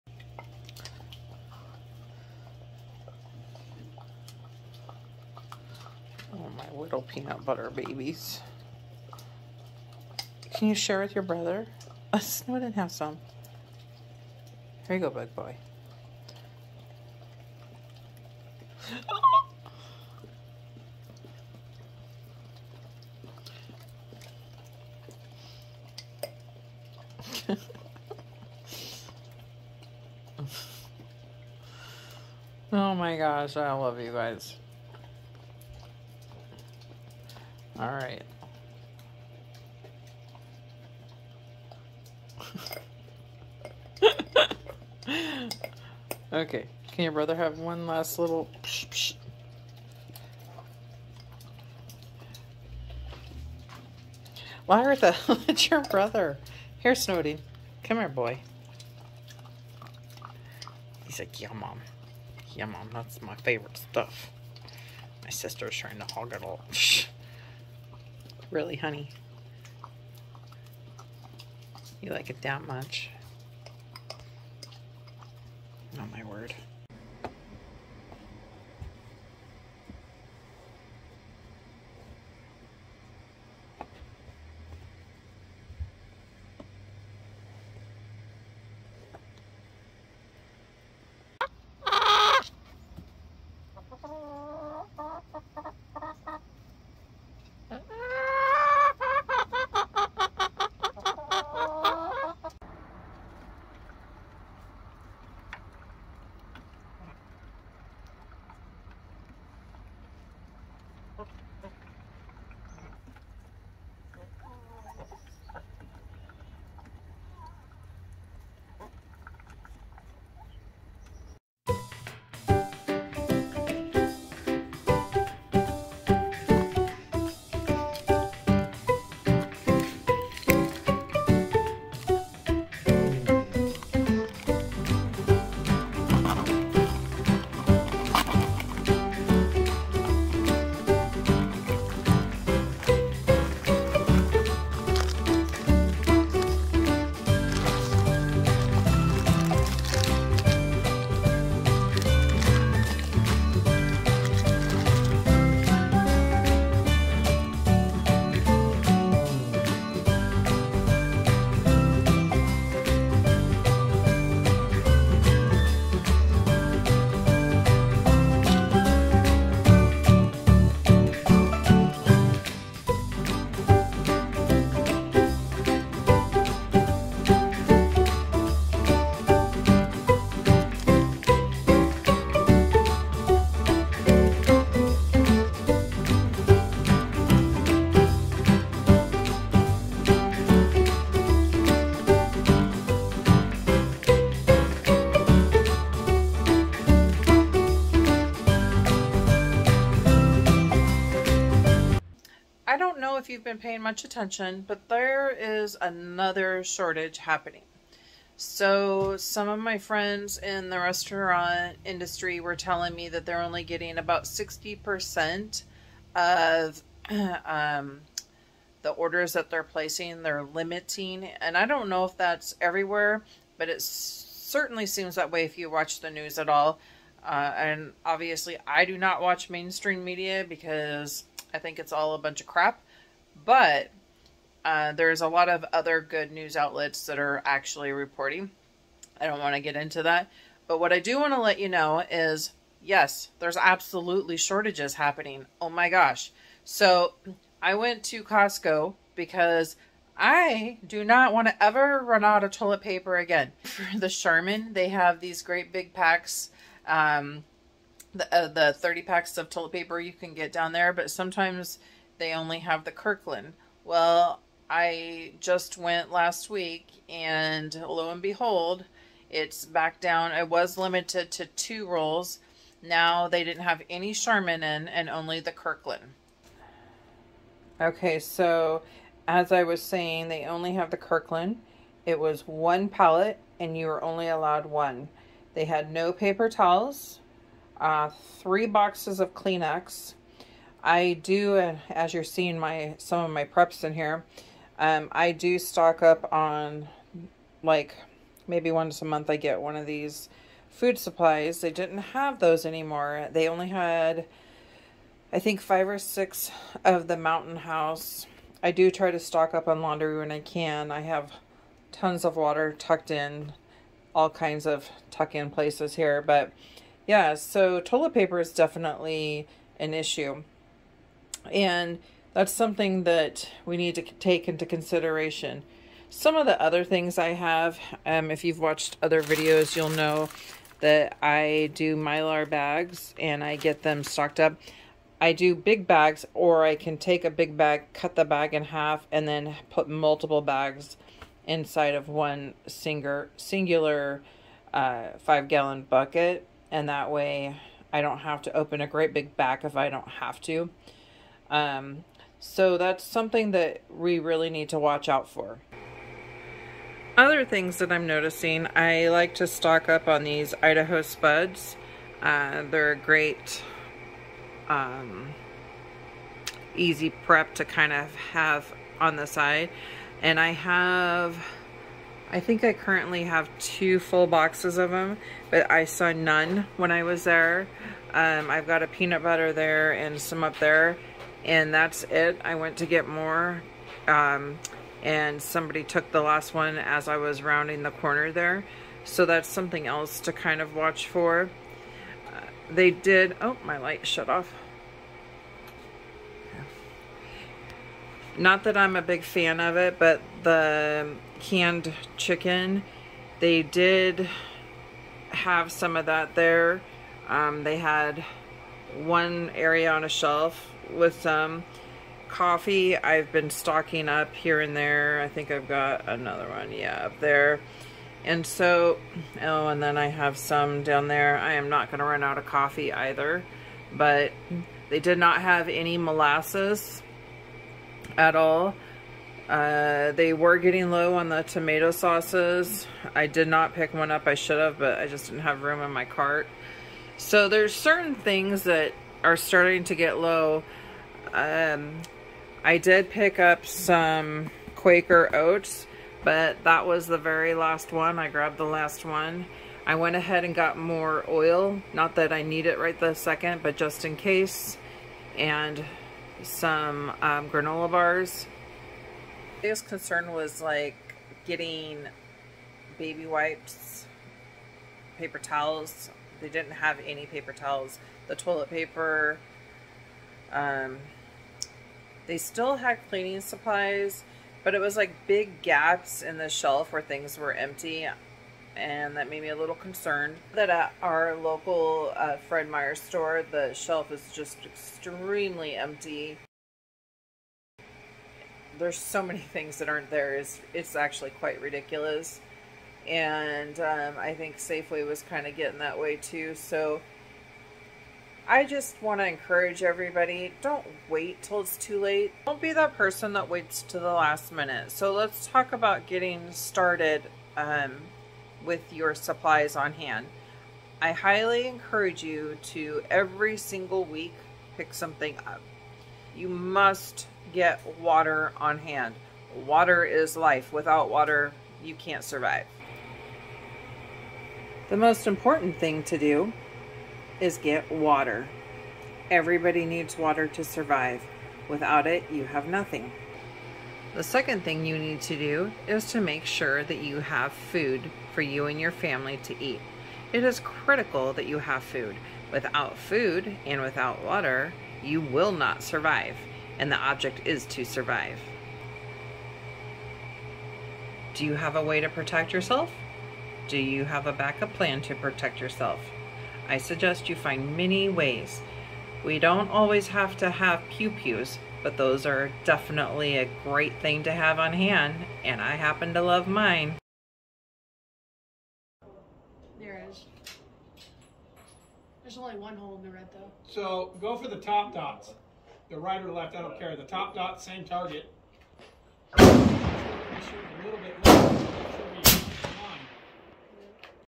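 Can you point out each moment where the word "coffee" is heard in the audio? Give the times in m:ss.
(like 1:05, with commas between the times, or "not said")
6:52, 7:02.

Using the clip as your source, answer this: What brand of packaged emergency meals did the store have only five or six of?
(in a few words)
Mountain House.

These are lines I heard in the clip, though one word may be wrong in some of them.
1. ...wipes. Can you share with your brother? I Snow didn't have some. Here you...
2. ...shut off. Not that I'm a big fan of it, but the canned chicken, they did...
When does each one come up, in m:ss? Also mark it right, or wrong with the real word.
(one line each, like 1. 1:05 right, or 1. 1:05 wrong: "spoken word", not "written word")
1. 0:07 wrong: "babies", not "wipes"
2. 6:34 right.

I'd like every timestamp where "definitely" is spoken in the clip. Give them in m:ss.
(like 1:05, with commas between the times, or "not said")
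5:18, 9:22.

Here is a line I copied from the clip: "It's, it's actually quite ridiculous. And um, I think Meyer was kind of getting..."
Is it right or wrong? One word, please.
wrong.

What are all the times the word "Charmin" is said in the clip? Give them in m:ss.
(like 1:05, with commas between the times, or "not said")
4:14, 4:34.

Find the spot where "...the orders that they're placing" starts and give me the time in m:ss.
3:38.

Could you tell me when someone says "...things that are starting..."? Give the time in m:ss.
7:18.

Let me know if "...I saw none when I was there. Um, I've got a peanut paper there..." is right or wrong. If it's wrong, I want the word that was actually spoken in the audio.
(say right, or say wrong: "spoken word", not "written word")
wrong: "butter", not "paper".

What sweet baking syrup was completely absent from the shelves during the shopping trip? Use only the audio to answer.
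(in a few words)
molasses.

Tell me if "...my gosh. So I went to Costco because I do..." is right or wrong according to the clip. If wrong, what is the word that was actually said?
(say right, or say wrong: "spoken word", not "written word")
right.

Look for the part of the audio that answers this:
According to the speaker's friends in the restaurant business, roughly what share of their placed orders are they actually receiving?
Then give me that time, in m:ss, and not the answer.
3:34.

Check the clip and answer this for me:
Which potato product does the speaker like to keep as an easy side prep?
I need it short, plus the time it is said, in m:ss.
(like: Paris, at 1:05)
Idaho Spuds, at 6:00.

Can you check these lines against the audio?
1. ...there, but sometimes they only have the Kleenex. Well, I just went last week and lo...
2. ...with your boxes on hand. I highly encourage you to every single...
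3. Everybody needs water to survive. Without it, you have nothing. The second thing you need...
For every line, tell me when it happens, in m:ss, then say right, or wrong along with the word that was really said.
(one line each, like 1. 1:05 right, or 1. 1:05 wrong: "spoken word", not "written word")
1. 4:20 wrong: "Kirkland", not "Kleenex"
2. 8:28 wrong: "supplies", not "boxes"
3. 8:49 right.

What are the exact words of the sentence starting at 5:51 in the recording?
Um, so that's something that we really need to watch out for.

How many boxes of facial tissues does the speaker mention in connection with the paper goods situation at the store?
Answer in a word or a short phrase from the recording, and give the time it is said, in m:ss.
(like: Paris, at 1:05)
3, at 4:48.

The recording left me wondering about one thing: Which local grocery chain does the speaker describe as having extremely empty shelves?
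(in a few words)
Fred Meyer.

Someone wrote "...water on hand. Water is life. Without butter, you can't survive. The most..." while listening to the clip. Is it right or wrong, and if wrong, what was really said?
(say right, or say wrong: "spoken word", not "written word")
wrong: "water", not "butter".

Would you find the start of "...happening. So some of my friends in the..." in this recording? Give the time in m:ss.
3:27.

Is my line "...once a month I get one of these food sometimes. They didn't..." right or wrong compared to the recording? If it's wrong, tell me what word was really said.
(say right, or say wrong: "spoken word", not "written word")
wrong: "supplies", not "sometimes".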